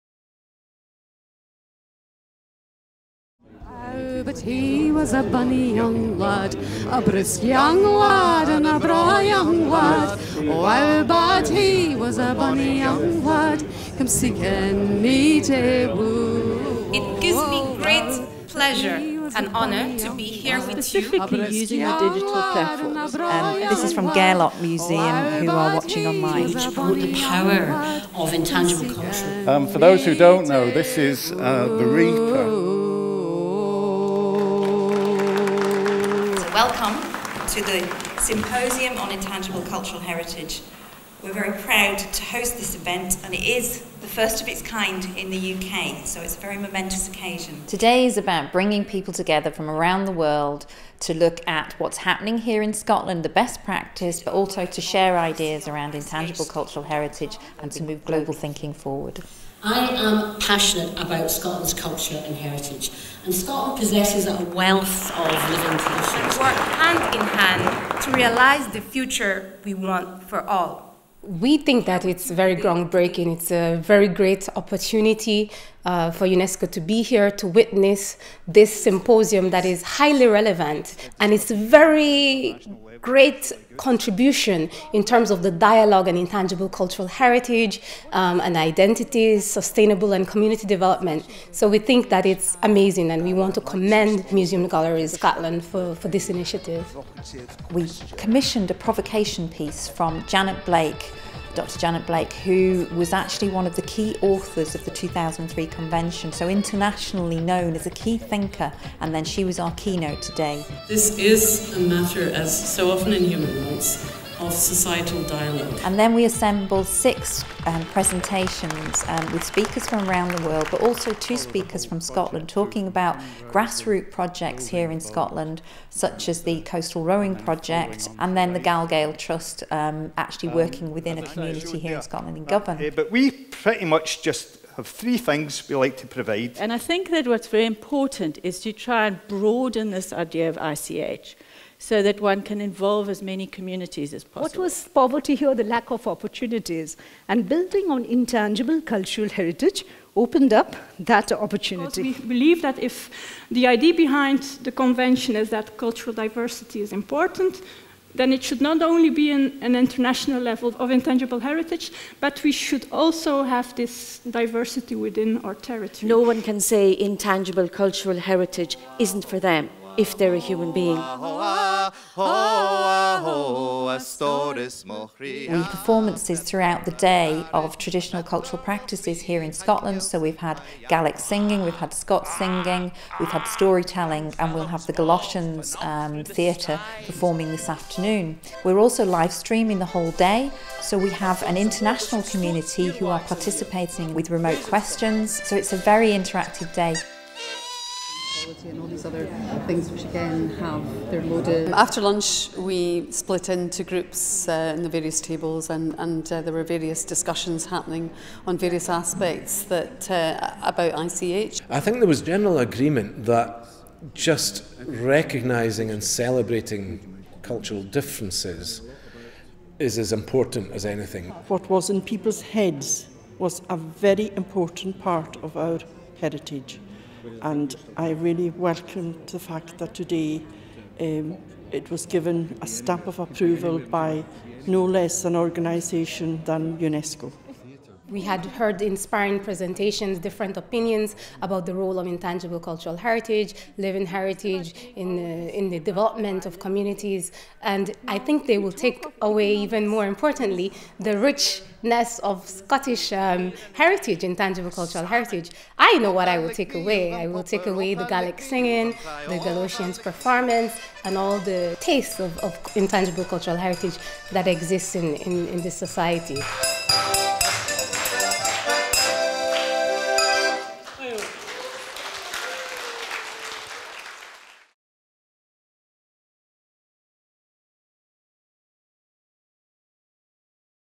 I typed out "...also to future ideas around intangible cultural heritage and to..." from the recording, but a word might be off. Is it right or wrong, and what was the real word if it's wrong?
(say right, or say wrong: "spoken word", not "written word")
wrong: "share", not "future".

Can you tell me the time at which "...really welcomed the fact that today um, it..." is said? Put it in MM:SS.
03:48.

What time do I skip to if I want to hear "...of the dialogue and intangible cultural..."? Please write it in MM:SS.
01:25.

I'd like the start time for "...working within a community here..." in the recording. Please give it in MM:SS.
02:10.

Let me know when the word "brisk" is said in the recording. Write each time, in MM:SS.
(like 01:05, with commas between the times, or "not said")
00:07.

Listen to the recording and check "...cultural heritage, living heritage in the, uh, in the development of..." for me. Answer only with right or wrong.
right.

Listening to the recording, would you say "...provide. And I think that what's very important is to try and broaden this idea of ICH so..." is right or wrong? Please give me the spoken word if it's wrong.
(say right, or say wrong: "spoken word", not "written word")
right.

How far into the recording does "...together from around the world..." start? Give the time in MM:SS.
00:49.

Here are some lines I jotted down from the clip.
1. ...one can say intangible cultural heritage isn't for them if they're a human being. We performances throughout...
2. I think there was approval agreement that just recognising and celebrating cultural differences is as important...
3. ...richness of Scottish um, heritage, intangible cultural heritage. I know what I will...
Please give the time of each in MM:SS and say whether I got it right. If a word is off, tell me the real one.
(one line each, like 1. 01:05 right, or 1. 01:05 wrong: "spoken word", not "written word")
1. 02:46 right
2. 03:31 wrong: "general", not "approval"
3. 04:11 right.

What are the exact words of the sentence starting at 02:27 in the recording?
And building on intangible cultural heritage opened up that opportunity.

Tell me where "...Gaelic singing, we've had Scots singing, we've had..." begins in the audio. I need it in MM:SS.
03:00.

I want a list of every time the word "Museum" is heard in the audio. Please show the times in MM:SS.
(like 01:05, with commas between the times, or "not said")
00:24, 01:34.